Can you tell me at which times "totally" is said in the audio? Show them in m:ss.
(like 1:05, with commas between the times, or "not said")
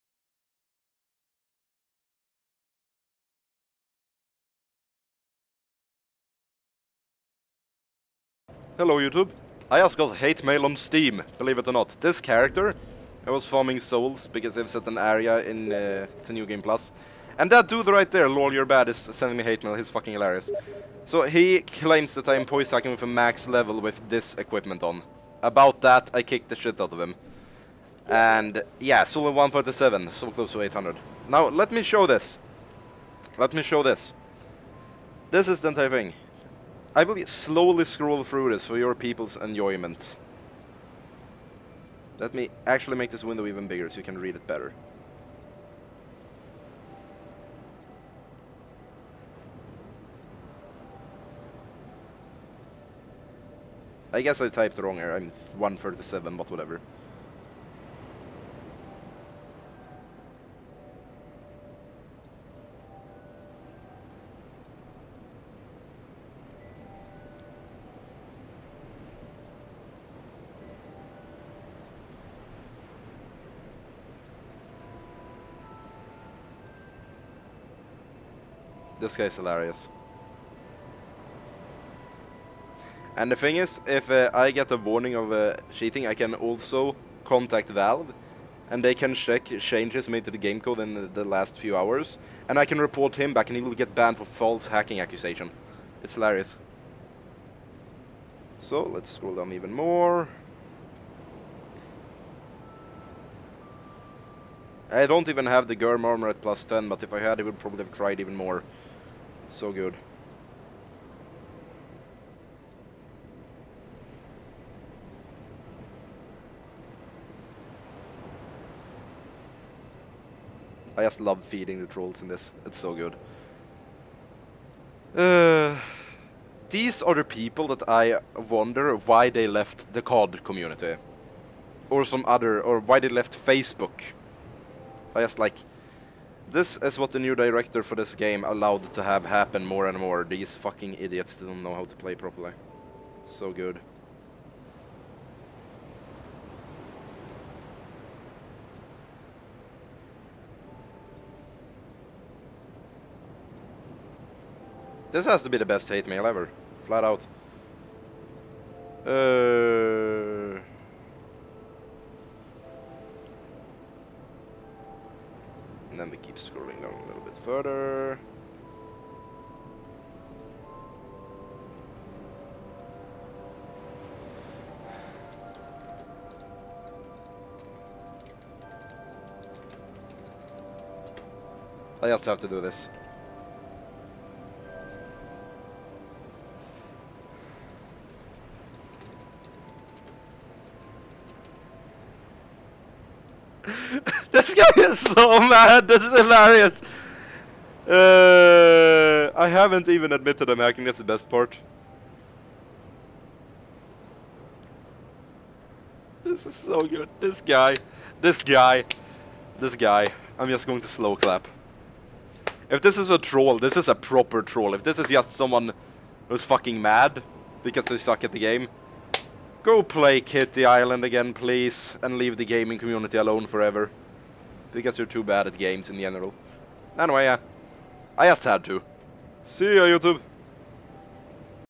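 not said.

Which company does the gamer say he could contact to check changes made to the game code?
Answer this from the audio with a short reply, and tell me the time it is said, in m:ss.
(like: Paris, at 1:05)
Valve, at 1:27.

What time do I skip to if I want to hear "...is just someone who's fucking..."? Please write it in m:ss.
3:34.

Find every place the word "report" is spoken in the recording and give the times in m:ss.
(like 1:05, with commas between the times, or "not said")
1:32.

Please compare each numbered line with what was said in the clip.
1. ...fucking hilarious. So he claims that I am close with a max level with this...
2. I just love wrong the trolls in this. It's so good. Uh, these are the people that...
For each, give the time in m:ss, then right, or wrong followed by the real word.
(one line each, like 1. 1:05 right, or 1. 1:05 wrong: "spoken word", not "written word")
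1. 0:19 wrong: "poise", not "close"
2. 2:00 wrong: "feeding", not "wrong".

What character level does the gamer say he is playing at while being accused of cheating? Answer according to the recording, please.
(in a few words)
137.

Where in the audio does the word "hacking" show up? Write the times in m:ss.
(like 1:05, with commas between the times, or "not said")
1:34, 3:20.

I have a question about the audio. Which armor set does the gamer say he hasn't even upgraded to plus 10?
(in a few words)
Gyrm armor.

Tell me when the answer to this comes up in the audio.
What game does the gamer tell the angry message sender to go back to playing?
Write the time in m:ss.
3:40.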